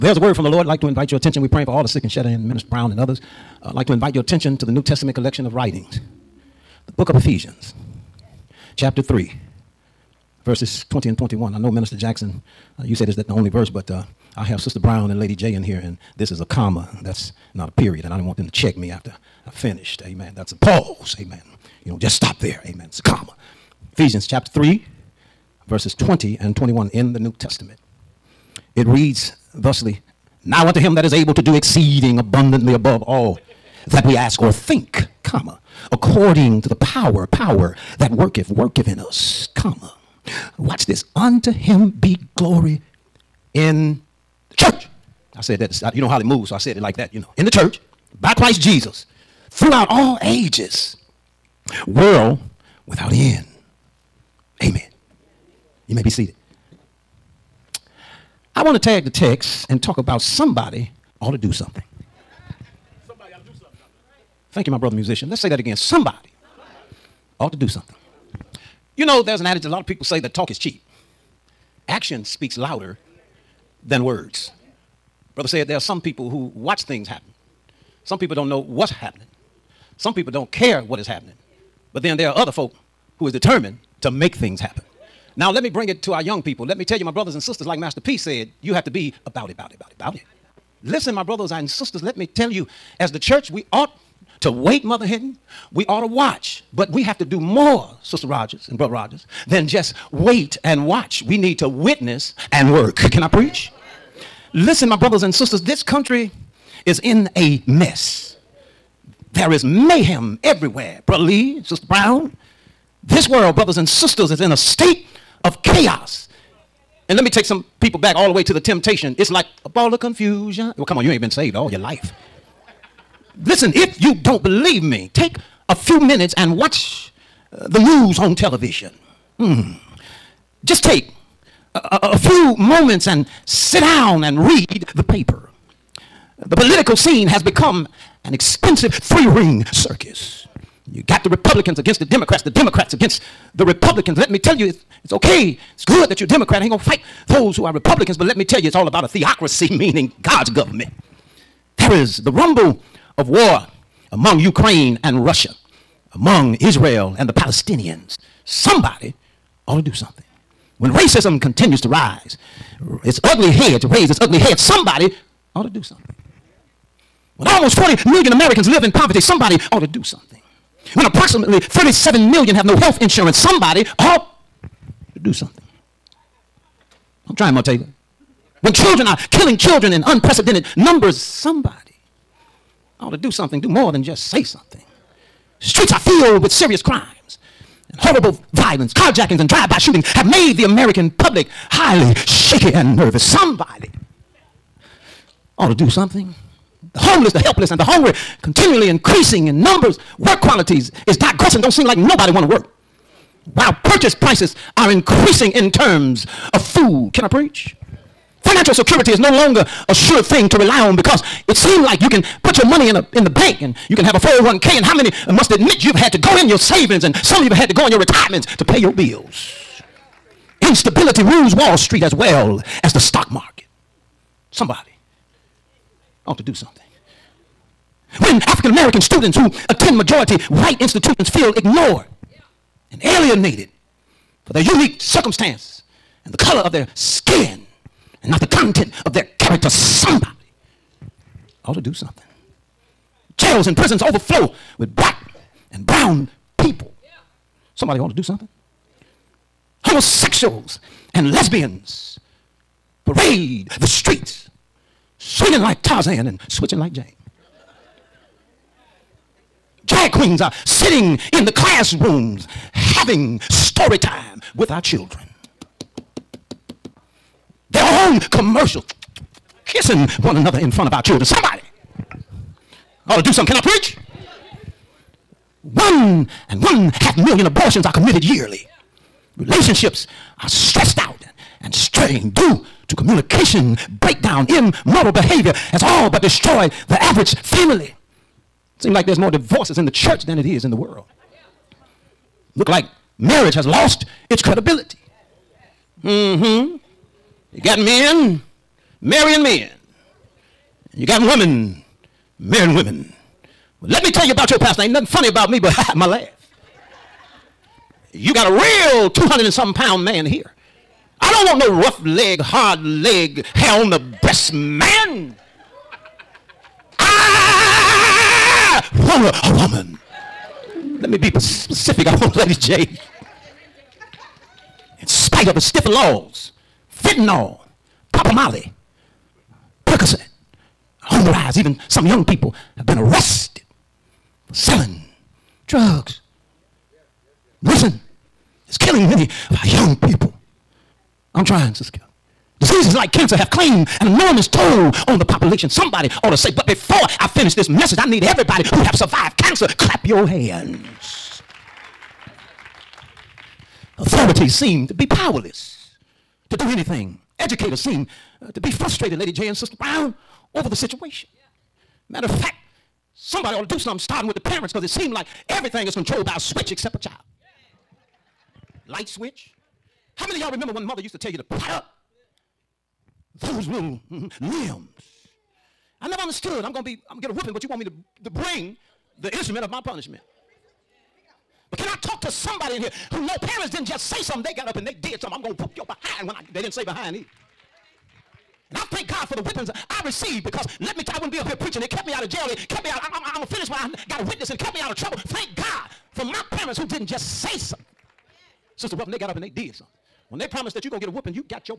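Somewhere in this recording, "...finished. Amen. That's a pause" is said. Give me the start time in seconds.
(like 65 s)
19 s.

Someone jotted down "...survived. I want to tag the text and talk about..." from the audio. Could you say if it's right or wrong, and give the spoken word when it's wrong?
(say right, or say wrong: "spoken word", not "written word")
wrong: "seated", not "survived".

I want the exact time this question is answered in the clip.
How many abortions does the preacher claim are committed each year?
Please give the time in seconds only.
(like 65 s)
275 s.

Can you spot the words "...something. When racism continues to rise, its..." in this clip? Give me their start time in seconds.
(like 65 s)
159 s.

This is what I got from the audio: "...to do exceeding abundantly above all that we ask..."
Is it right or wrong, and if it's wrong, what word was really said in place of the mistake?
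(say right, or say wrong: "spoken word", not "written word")
right.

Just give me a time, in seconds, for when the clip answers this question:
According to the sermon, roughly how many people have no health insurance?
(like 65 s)
171 s.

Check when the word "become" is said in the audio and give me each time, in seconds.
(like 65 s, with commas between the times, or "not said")
137 s.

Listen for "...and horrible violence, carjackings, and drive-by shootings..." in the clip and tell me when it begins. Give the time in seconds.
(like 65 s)
187 s.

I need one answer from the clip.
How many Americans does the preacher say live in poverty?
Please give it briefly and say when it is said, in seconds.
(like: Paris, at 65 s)
40 million, at 167 s.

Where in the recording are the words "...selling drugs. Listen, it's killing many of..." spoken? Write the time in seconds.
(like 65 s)
334 s.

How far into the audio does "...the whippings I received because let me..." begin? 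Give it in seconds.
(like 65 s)
389 s.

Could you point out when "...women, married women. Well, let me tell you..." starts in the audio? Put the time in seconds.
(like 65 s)
301 s.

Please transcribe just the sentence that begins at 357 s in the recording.
Educators seem uh, to be frustrated, Lady J and Sister Brown, over the situation.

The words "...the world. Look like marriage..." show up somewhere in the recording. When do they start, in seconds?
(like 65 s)
290 s.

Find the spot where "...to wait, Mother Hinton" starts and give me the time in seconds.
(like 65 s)
94 s.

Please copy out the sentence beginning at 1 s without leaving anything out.
We're praying for all the sick and shut in, Minister Brown and others.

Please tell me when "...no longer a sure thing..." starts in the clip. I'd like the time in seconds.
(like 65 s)
209 s.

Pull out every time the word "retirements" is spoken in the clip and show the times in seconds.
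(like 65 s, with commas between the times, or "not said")
217 s.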